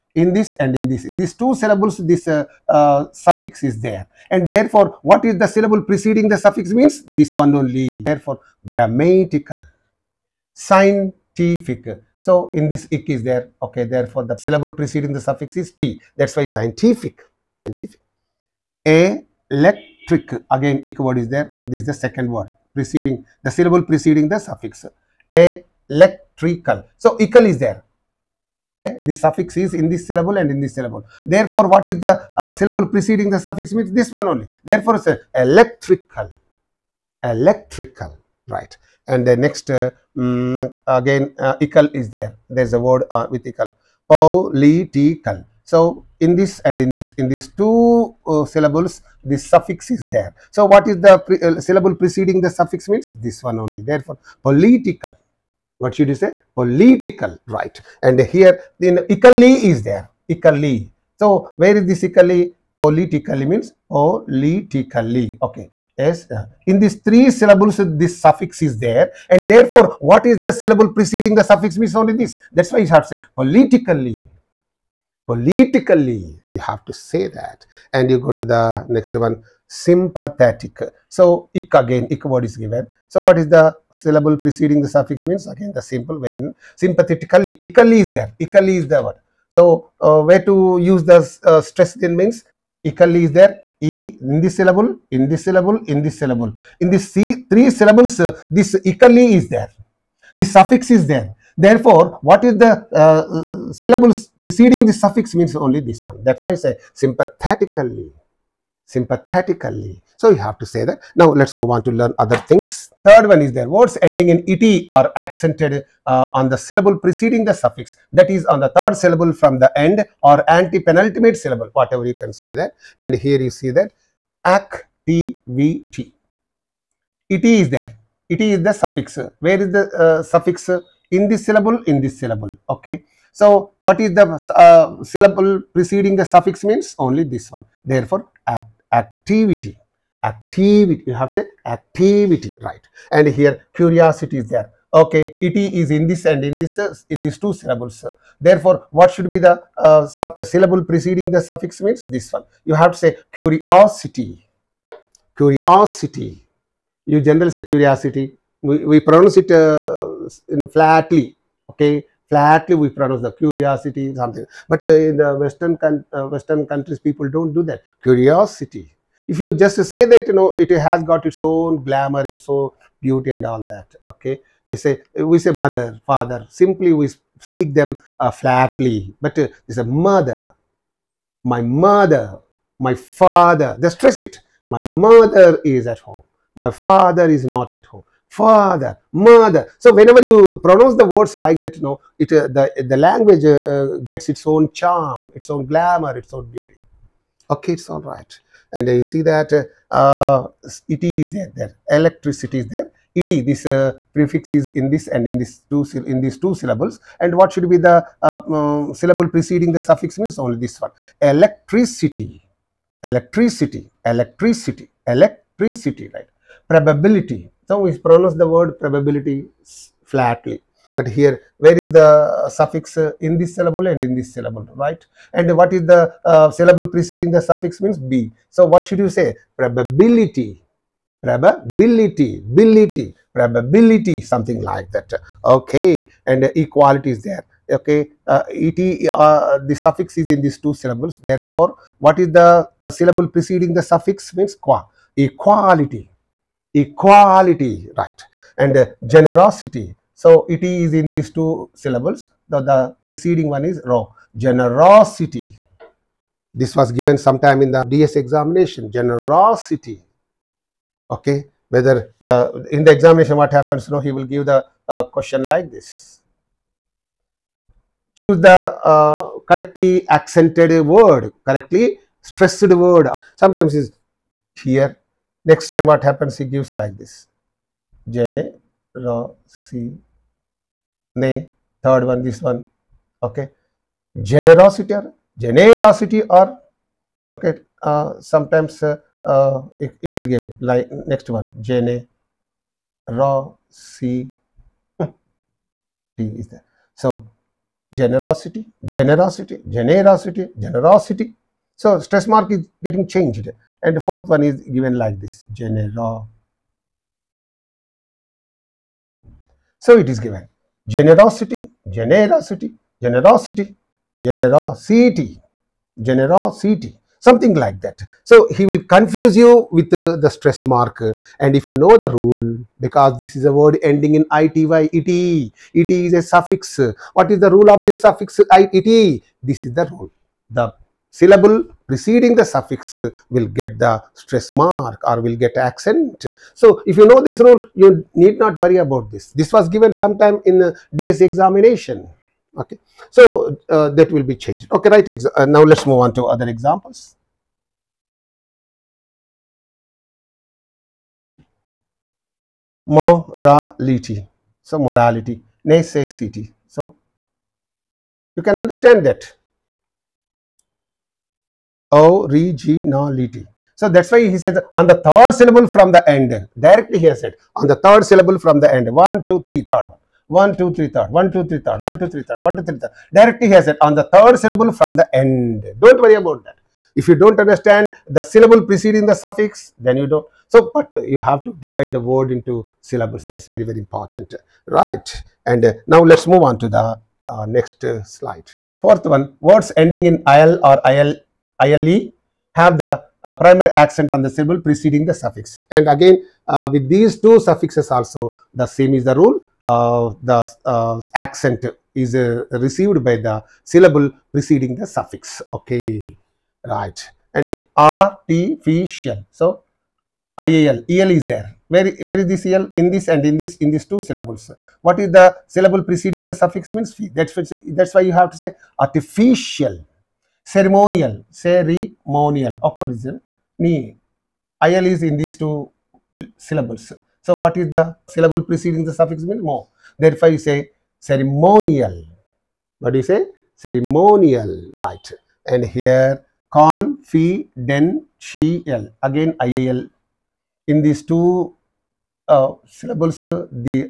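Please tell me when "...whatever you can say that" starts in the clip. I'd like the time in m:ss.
2:01.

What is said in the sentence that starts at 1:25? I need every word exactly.
Again, the simple when sympathetically, equally is there, Equally is the word.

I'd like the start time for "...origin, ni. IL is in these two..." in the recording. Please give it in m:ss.
7:02.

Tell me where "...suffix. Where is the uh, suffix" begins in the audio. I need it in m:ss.
2:08.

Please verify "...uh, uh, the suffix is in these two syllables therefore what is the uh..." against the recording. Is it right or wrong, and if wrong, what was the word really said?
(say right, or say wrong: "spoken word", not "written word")
right.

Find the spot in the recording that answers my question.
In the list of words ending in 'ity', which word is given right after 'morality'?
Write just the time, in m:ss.
5:55.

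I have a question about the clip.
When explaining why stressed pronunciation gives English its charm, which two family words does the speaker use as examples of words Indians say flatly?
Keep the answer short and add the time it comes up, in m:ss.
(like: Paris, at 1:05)
mother, father, at 2:55.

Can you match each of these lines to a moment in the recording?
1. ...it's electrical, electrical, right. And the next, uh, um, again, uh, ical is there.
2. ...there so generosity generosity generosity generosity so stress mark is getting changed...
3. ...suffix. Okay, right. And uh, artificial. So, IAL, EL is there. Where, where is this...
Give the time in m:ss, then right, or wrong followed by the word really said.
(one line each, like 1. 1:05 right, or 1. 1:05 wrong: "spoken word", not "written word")
1. 0:34 right
2. 4:56 right
3. 6:44 right.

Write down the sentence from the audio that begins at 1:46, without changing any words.
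That's why I say sympathetically, sympathetically so you have to say that.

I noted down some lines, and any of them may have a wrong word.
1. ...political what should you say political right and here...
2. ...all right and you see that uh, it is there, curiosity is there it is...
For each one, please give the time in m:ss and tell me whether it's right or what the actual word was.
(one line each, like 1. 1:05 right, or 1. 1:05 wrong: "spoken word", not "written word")
1. 0:54 right
2. 3:17 wrong: "electricity", not "curiosity".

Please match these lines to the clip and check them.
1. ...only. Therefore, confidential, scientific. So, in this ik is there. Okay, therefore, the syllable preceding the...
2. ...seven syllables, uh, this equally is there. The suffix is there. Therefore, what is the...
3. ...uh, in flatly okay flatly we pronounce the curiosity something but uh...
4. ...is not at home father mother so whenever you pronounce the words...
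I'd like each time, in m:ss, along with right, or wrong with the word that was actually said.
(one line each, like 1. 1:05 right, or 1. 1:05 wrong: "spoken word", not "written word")
1. 0:07 wrong: "grammatical", not "confidential"
2. 1:37 wrong: "three", not "seven"
3. 2:39 right
4. 3:07 right.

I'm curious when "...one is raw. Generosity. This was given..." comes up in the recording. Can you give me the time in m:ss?
4:13.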